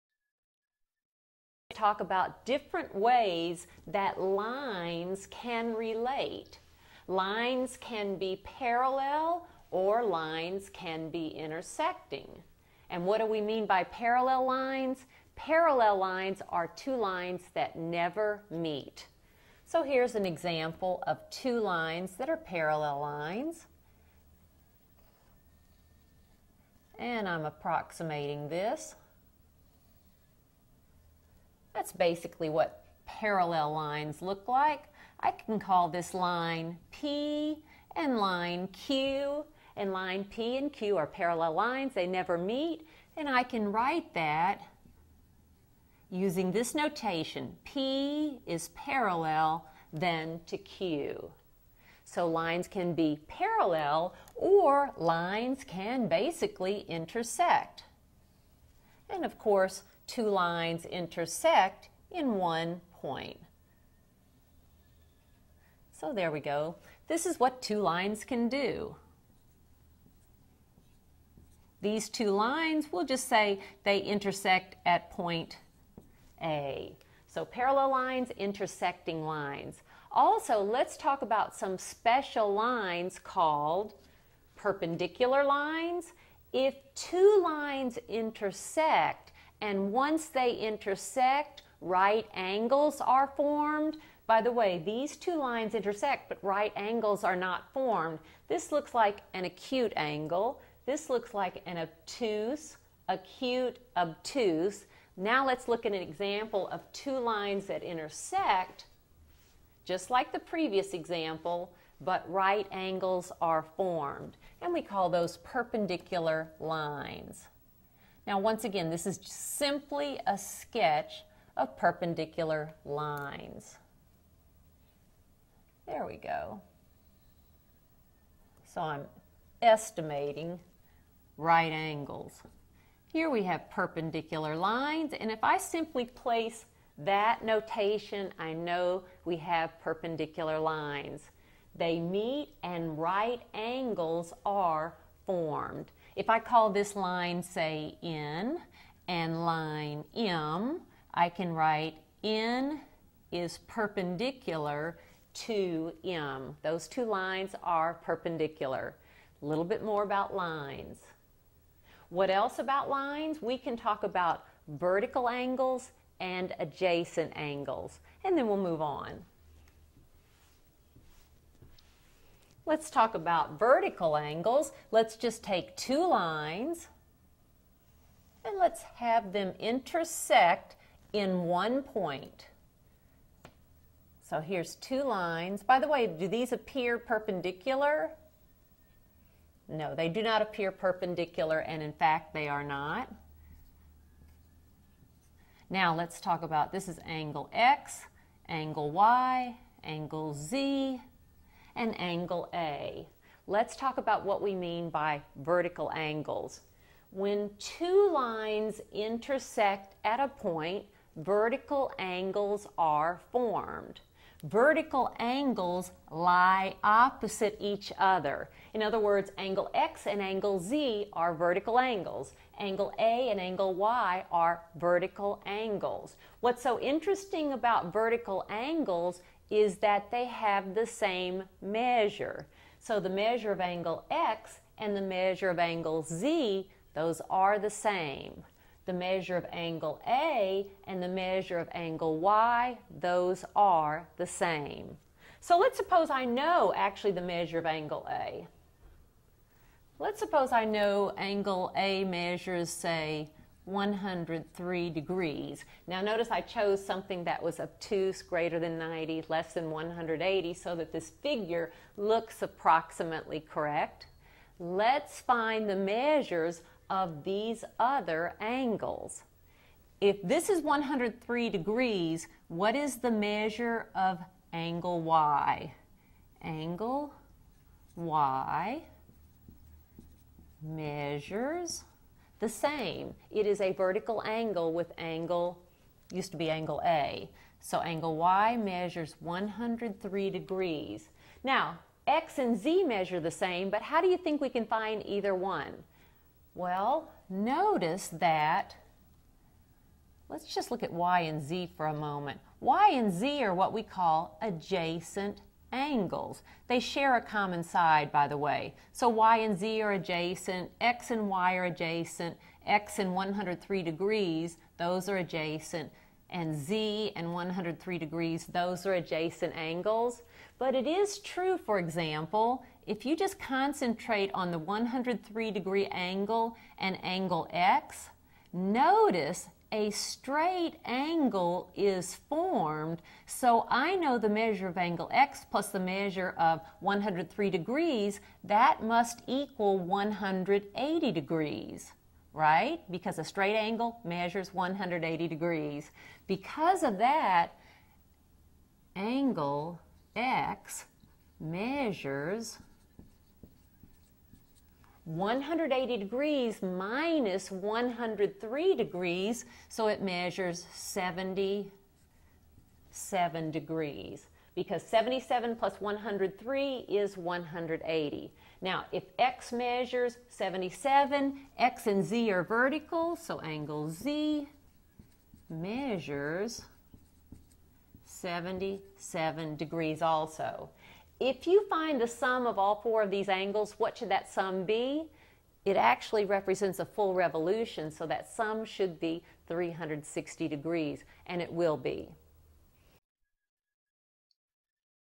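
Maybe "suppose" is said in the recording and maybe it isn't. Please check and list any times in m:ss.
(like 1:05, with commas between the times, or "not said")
4:05, 4:10.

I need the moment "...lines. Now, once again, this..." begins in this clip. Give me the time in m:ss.
1:56.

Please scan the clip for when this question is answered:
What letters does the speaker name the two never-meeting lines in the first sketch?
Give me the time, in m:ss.
0:39.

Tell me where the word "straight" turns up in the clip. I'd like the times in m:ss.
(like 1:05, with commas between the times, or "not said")
5:29, 5:43.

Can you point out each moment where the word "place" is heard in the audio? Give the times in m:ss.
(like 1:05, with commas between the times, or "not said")
2:16.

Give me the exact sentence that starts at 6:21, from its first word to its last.
If you find the sum of all four of these angles, what should that sum be?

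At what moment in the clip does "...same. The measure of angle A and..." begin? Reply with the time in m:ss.
3:57.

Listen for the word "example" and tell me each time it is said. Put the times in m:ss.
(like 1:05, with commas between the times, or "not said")
0:20, 1:46, 1:50, 5:21.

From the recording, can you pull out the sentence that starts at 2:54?
Let's just take two lines and let's have them intersect in one point.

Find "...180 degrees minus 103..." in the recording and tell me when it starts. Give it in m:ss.
5:55.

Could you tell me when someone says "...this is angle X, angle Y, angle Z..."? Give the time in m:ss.
3:16.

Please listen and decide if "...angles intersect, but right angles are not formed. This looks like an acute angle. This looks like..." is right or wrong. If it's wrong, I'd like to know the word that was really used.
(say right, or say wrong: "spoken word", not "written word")
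wrong: "lines", not "angles".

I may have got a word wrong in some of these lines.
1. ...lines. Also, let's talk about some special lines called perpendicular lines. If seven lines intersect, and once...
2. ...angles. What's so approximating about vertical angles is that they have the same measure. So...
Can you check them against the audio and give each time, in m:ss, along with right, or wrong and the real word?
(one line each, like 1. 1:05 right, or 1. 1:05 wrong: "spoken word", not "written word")
1. 1:19 wrong: "two", not "seven"
2. 3:45 wrong: "interesting", not "approximating".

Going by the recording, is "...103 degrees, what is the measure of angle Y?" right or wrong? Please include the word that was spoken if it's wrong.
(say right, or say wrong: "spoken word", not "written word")
right.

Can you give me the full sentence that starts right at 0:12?
And what do we mean by parallel lines?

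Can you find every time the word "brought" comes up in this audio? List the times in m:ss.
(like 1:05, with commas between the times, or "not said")
not said.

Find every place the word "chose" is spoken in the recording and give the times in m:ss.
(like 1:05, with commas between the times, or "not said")
4:16.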